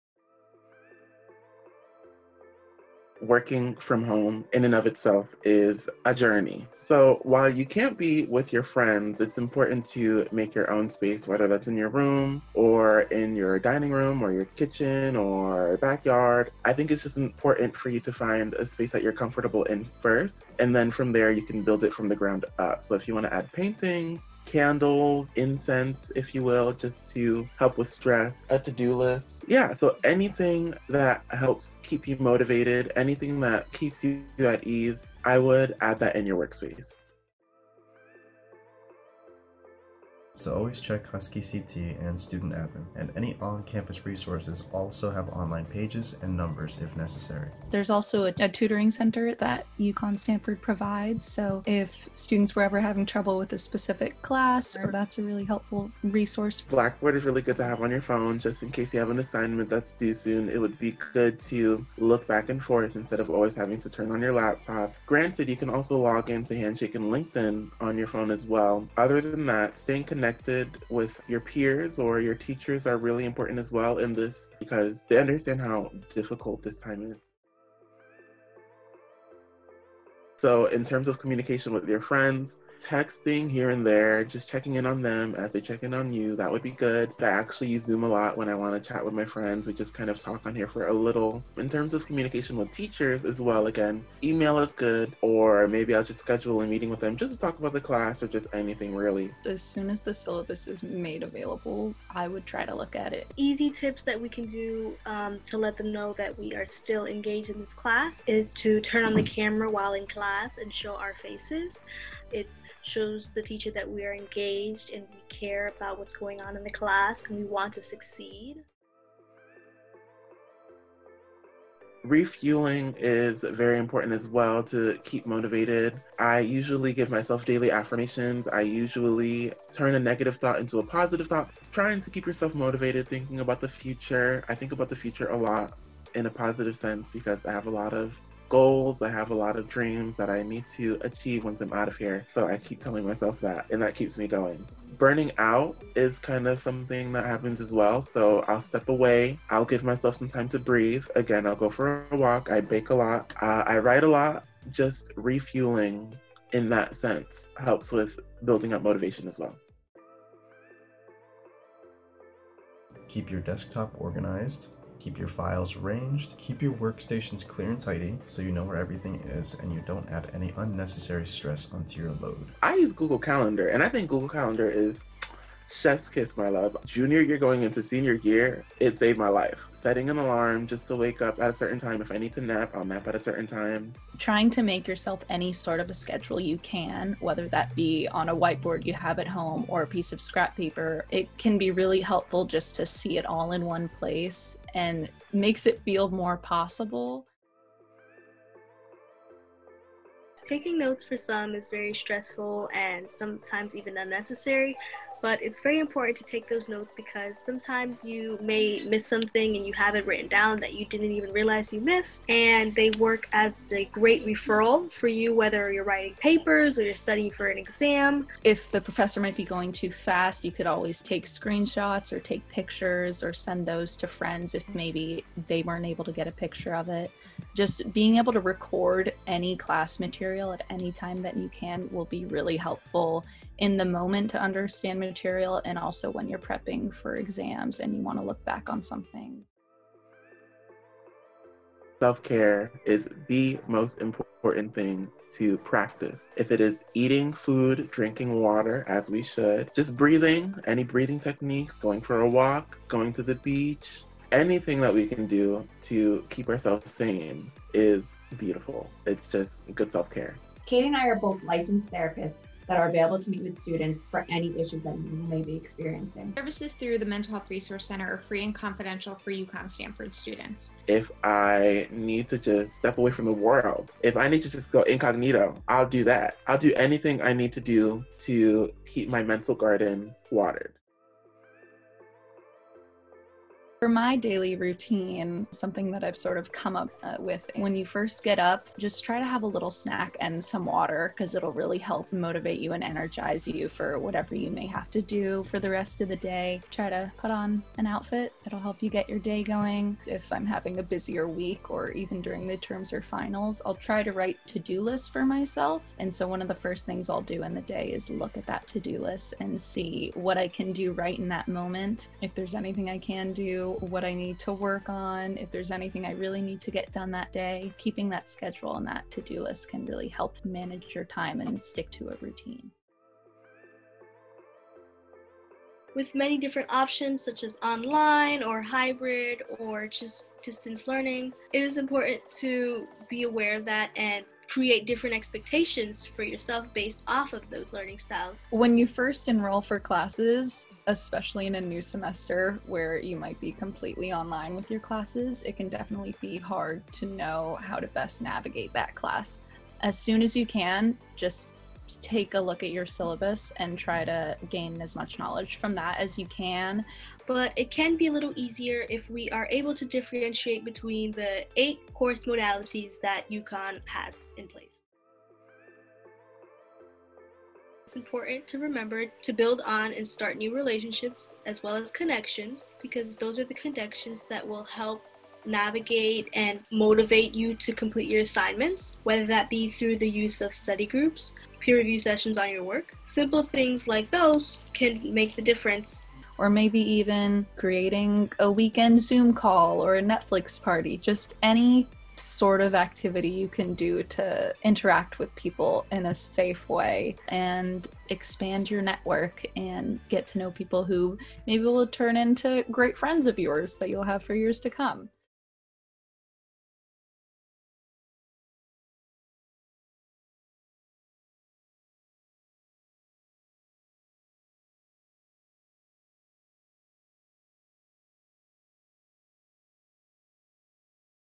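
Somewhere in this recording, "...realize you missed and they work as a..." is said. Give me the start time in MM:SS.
03:31.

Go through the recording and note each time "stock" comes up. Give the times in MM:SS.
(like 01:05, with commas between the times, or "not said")
not said.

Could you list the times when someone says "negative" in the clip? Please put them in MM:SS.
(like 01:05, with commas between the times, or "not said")
02:09.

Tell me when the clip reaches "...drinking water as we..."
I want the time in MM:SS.
04:07.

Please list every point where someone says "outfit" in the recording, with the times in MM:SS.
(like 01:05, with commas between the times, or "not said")
04:57.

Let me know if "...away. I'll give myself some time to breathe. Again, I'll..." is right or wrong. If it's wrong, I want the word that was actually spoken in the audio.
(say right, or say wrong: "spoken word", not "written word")
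right.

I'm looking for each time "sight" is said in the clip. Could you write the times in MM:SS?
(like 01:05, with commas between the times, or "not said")
not said.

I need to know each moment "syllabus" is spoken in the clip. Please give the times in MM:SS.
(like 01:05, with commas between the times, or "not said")
01:40, 05:52.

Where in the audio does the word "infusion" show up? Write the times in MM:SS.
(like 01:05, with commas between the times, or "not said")
not said.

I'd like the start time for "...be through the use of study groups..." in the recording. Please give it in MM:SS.
06:19.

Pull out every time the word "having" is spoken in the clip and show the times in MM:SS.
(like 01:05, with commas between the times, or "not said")
00:52, 01:03, 05:00.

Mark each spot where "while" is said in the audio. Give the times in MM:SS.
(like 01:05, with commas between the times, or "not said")
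00:07, 01:49.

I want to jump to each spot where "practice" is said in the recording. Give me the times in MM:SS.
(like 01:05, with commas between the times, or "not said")
04:05.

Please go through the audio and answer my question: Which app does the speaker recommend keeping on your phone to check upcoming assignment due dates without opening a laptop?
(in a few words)
Blackboard.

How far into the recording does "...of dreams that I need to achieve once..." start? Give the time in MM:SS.
02:19.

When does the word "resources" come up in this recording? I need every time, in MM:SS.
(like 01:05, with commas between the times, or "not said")
00:44, 00:56, 04:27.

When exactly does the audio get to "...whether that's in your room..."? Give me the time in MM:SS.
00:11.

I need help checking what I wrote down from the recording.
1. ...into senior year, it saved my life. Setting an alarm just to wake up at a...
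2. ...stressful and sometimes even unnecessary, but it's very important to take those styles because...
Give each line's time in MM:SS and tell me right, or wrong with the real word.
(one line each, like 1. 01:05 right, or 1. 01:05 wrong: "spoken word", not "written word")
1. 02:57 right
2. 03:21 wrong: "notes", not "styles".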